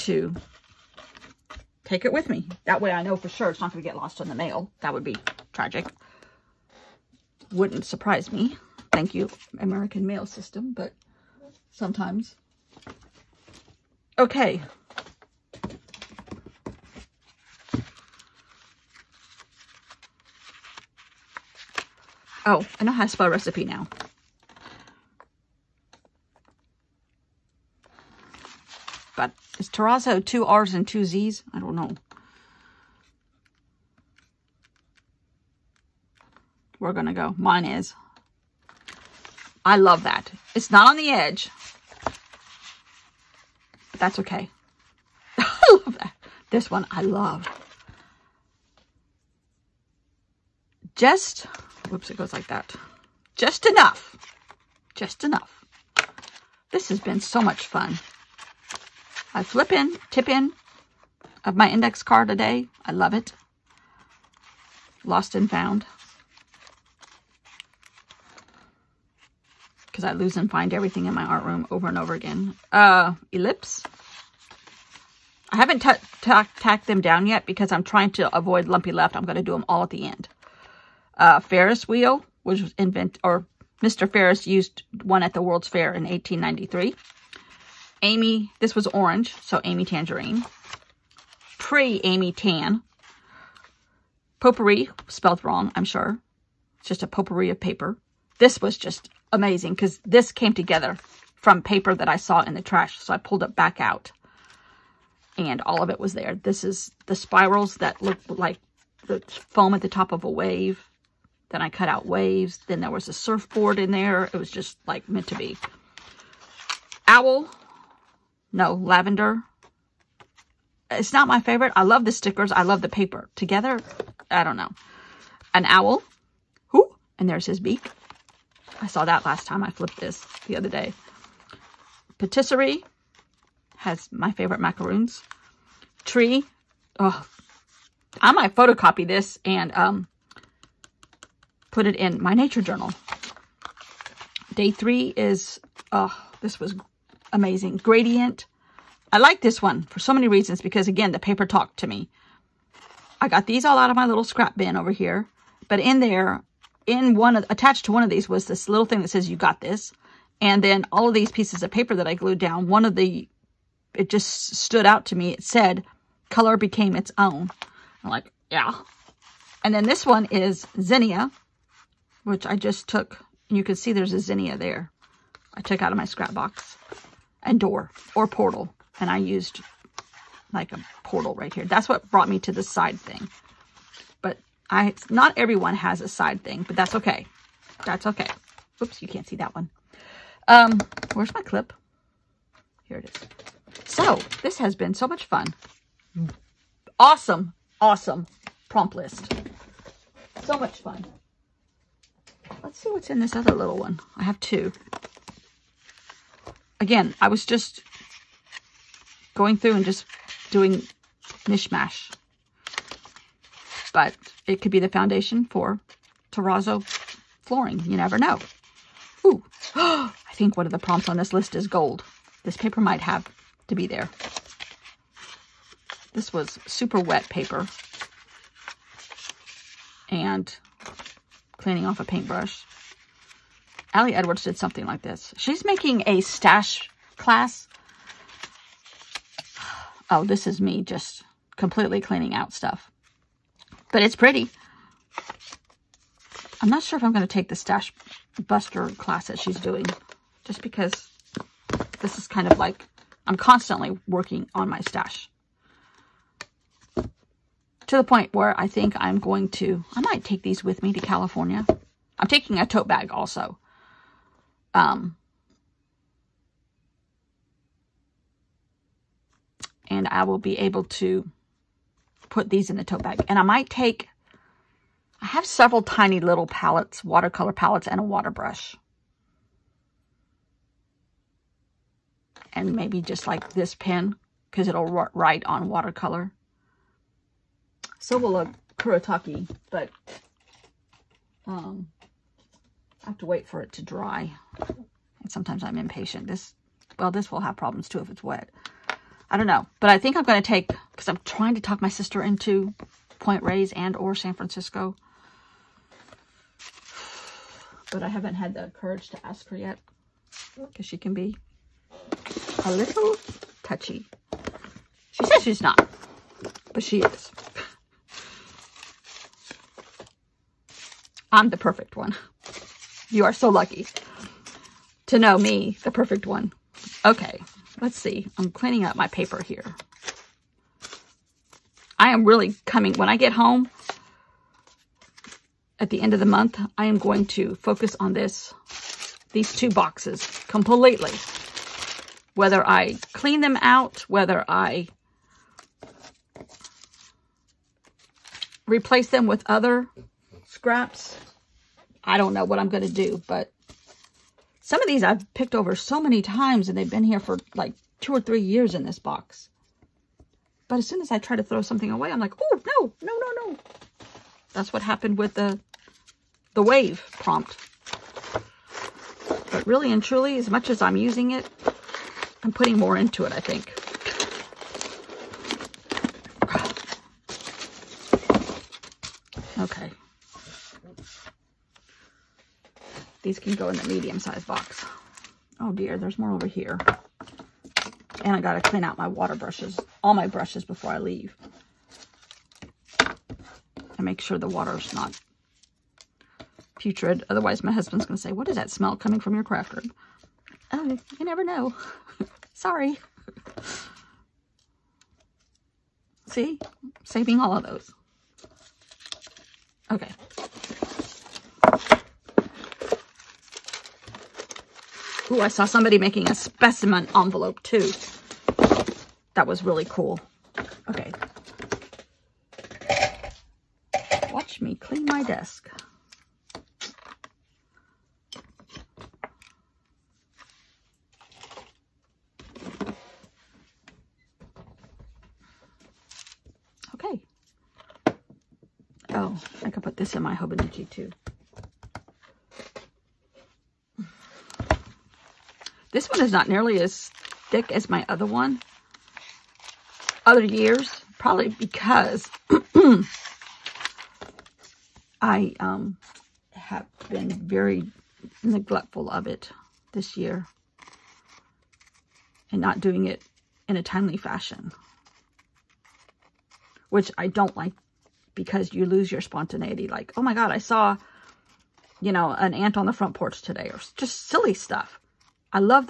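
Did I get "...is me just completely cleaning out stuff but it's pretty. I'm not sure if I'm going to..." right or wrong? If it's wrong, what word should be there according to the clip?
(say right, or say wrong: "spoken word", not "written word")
right.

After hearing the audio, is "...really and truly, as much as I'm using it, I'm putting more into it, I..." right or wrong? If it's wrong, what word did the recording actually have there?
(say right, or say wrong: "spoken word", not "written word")
right.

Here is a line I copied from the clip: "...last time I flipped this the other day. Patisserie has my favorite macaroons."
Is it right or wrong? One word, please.
right.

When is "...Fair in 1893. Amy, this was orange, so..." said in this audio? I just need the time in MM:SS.
01:25.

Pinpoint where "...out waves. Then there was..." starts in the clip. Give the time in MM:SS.
01:51.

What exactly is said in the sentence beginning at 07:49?
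Like, oh my God, I saw, you know, an ant on the front porch today or just silly stuff.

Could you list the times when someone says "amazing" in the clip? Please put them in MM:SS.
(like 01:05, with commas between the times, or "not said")
01:39, 02:27.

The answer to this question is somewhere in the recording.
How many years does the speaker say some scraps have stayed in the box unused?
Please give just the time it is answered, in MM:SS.
05:57.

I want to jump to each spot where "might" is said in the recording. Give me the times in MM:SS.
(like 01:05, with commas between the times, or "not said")
02:18, 03:42, 04:19, 04:33.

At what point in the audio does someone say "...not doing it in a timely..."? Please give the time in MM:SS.
07:42.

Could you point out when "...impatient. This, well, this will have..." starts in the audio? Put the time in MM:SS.
04:55.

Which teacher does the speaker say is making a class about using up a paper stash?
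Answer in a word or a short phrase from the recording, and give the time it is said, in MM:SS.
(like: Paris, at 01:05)
Allie Edwards, at 03:53.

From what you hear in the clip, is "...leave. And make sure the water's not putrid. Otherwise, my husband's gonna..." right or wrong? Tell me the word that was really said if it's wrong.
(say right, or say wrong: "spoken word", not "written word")
right.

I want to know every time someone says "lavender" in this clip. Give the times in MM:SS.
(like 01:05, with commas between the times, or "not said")
01:58.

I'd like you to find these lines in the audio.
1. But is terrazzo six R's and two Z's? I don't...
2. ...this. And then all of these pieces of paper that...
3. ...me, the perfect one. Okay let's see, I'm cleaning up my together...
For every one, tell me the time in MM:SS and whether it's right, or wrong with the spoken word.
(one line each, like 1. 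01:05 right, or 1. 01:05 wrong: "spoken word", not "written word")
1. 00:29 wrong: "two", not "six"
2. 02:39 right
3. 05:25 wrong: "paper", not "together".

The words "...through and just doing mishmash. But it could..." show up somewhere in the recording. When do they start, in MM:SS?
03:29.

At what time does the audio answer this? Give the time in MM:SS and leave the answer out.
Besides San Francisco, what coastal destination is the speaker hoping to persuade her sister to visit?
05:03.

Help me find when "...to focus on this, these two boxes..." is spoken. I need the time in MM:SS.
05:37.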